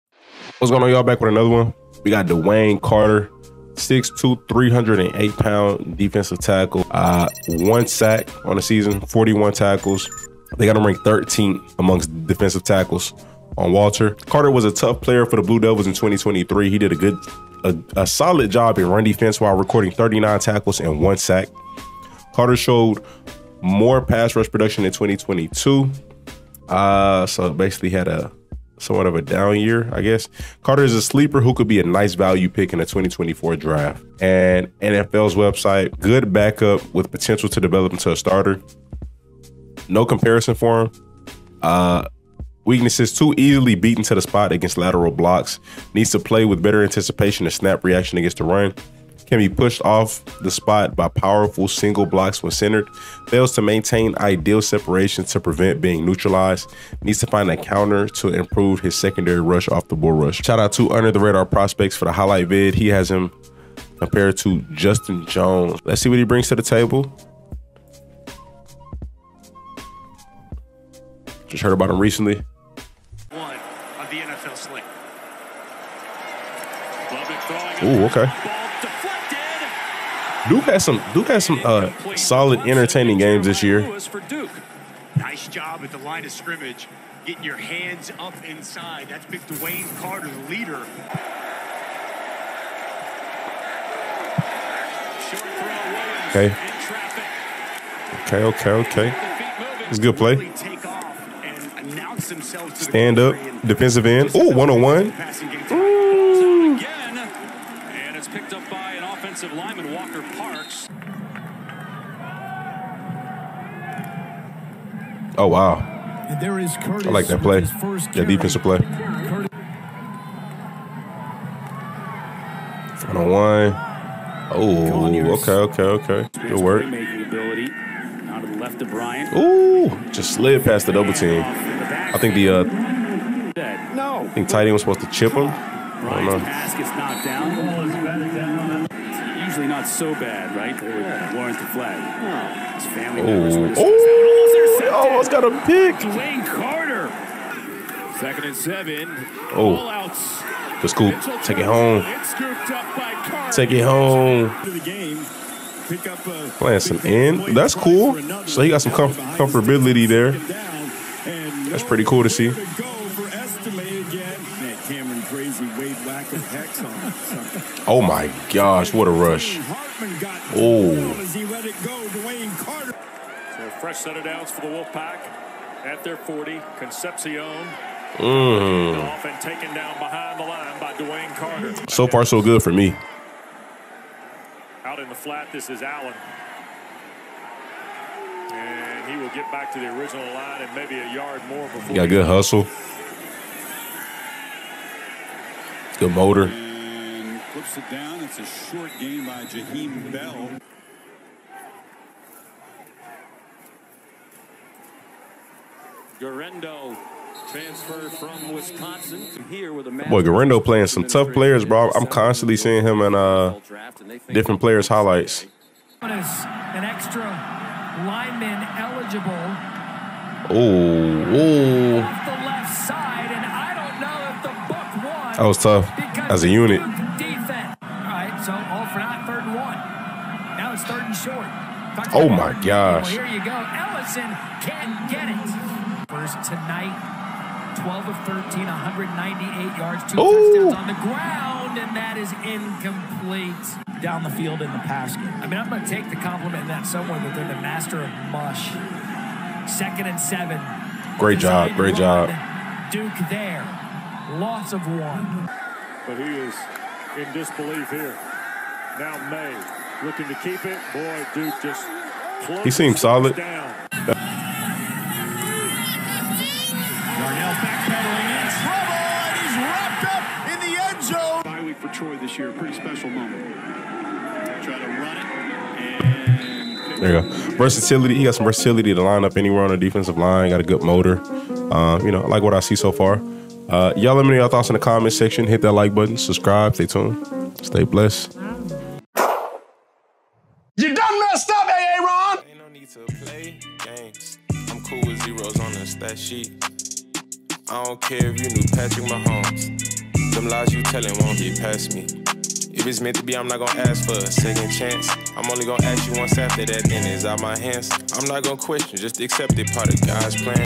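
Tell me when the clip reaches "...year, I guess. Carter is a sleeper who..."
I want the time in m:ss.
0:29.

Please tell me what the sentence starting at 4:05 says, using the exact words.
I mean, I'm going to take the compliment in that somewhere that they're the master of mush.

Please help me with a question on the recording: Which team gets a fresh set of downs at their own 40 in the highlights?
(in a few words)
Wolfpack.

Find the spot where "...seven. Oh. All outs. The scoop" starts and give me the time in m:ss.
2:28.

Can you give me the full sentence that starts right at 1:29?
That's big Dewayne Carter, the leader.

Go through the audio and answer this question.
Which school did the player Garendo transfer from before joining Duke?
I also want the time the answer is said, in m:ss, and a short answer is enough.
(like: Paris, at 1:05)
Wisconsin, at 3:28.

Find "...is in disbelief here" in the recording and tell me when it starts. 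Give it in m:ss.
4:16.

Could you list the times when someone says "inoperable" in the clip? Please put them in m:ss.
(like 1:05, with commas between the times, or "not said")
not said.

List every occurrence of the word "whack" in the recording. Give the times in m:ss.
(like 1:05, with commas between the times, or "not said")
2:46.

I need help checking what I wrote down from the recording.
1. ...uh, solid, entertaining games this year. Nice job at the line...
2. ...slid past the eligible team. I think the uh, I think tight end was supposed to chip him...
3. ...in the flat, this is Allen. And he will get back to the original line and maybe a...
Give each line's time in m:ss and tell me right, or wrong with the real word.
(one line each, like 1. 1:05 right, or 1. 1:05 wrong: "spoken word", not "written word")
1. 1:21 right
2. 2:10 wrong: "double", not "eligible"
3. 3:04 right.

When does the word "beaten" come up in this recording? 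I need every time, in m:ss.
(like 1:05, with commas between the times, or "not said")
0:43.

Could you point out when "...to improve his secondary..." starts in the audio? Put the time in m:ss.
0:58.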